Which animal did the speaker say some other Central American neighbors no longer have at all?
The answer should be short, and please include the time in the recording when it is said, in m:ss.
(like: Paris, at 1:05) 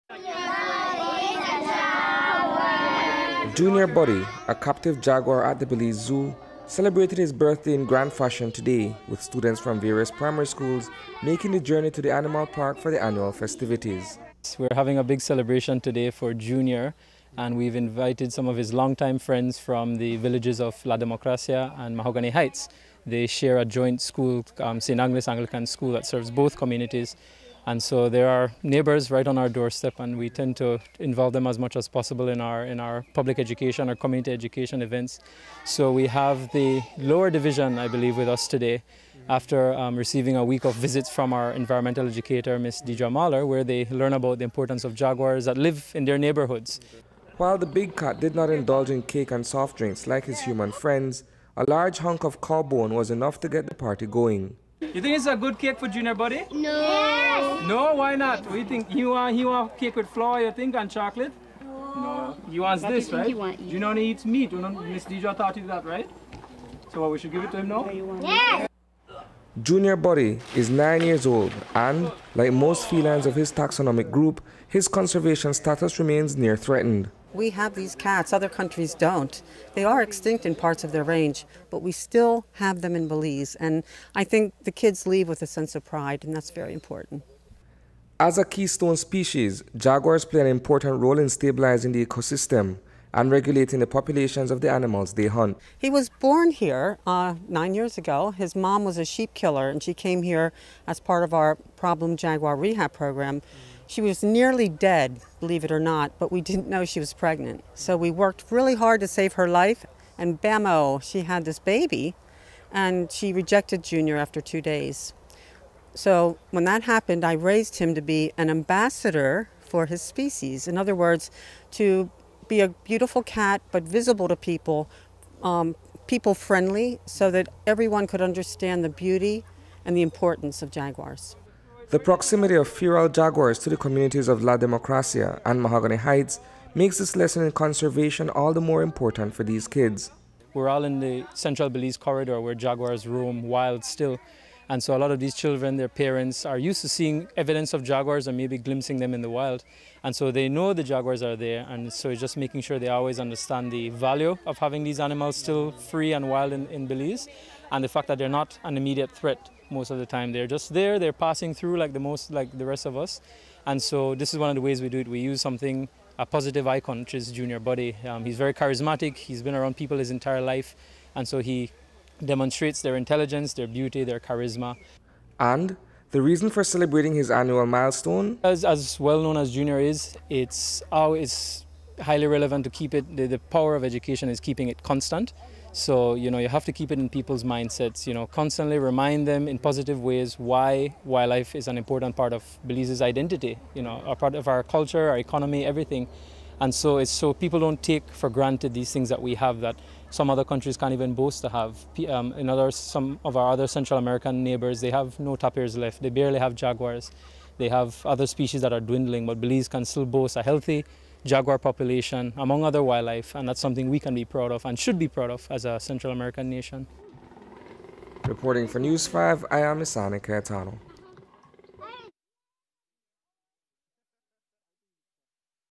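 Tapirs, at 3:25.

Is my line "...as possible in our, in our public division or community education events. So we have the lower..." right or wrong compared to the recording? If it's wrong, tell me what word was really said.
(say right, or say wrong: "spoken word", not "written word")
wrong: "education", not "division".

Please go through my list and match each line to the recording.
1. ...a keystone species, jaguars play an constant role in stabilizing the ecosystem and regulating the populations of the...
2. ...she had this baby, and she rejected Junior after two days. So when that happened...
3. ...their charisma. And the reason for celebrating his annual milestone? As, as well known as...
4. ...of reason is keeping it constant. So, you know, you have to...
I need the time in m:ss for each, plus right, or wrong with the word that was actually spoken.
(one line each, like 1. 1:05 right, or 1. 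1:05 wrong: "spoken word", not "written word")
1. 1:28 wrong: "important", not "constant"
2. 1:51 right
3. 2:54 right
4. 3:03 wrong: "education", not "reason".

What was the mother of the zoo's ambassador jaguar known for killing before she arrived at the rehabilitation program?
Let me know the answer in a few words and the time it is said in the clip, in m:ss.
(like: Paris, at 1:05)
Sheep, at 1:39.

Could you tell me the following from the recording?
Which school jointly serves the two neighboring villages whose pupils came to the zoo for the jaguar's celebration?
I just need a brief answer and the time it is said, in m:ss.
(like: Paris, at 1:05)
St. Agnes Anglican School, at 0:24.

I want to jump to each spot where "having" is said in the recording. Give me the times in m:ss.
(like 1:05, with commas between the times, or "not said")
0:14, 2:34.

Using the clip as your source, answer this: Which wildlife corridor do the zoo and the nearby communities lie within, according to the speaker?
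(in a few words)
Central Belize corridor.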